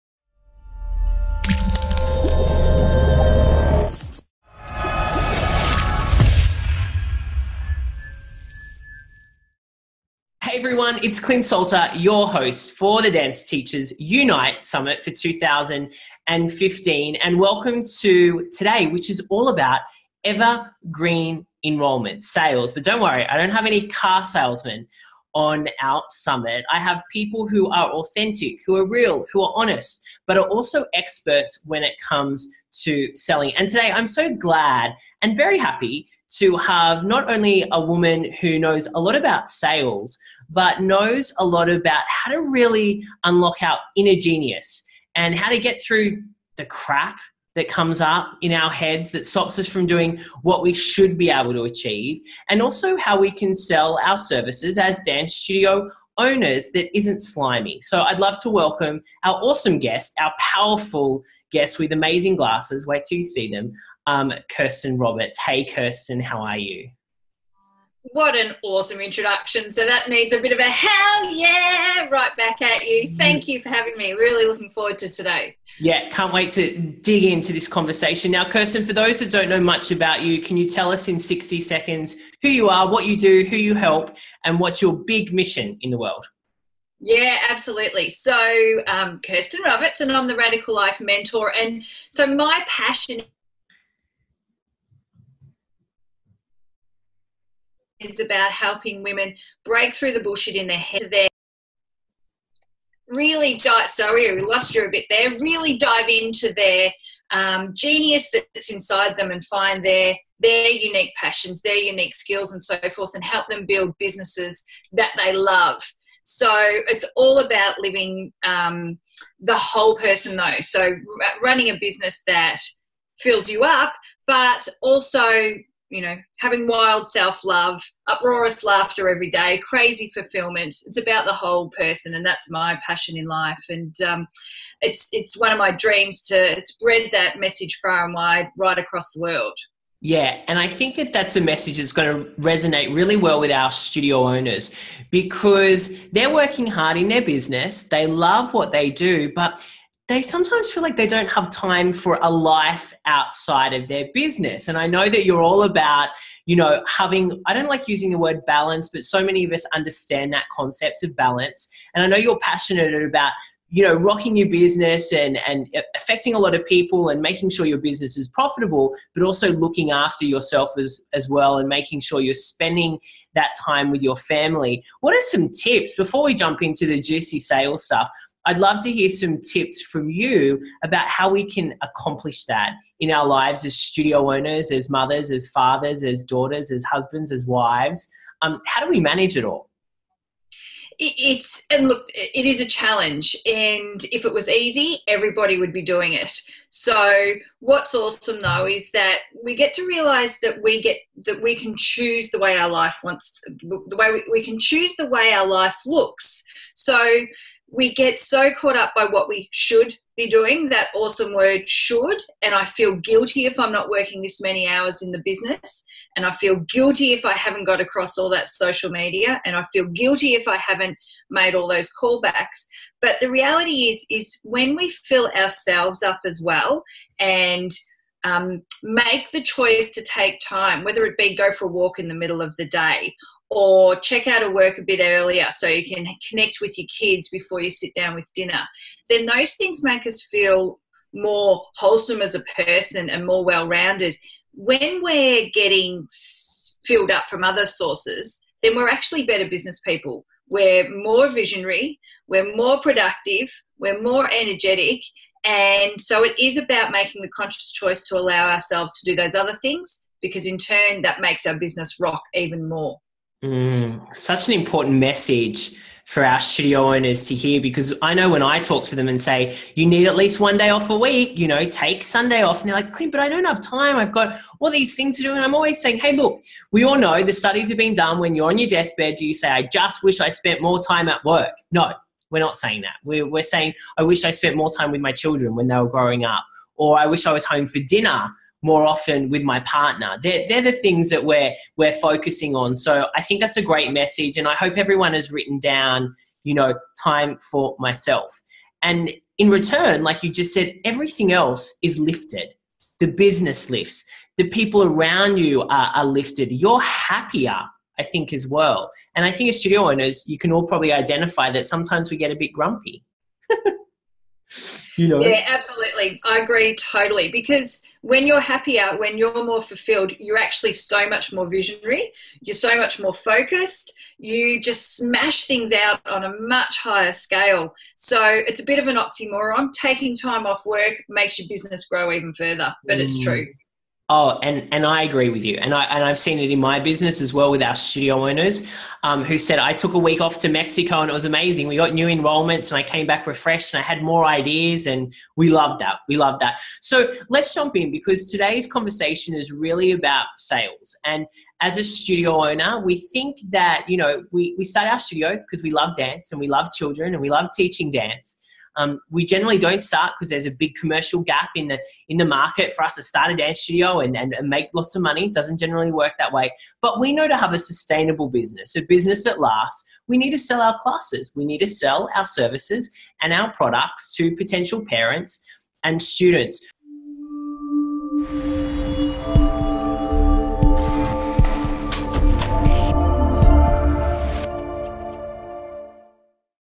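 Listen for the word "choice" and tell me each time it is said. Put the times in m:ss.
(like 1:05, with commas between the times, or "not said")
3:49, 4:17.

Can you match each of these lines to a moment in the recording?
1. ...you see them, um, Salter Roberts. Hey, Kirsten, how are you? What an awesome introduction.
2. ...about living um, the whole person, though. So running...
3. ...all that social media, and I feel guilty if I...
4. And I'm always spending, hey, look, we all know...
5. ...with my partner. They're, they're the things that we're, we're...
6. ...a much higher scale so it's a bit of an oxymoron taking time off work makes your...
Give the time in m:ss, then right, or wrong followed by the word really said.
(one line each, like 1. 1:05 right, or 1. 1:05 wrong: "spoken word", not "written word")
1. 1:03 wrong: "Kirsten", not "Salter"
2. 1:57 right
3. 3:38 right
4. 4:35 wrong: "saying", not "spending"
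5. 4:49 right
6. 5:26 right.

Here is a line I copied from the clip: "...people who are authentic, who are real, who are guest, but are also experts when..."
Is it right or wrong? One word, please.
wrong.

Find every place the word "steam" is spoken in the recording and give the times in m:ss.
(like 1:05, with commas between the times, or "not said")
not said.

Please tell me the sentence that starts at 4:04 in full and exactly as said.
When we're getting filled up from other sources, then we're actually better business people.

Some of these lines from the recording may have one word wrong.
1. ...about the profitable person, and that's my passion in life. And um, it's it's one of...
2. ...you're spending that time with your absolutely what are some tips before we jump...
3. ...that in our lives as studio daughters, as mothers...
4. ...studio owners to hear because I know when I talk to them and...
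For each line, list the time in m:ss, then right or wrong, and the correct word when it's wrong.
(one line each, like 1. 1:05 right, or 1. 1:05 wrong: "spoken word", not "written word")
1. 2:10 wrong: "whole", not "profitable"
2. 2:52 wrong: "family", not "absolutely"
3. 3:02 wrong: "owners", not "daughters"
4. 4:26 right.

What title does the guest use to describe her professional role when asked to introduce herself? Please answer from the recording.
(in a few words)
Radical Life Mentor.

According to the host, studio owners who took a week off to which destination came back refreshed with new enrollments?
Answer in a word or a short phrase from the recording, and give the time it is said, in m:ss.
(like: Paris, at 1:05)
Mexico, at 5:40.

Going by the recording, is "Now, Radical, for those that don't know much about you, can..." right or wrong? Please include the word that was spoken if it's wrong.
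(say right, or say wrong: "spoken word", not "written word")
wrong: "Kirsten", not "Radical".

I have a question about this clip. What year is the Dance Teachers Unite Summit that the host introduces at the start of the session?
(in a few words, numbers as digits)
2015.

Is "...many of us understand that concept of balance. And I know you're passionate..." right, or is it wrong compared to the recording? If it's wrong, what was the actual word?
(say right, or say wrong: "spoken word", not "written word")
right.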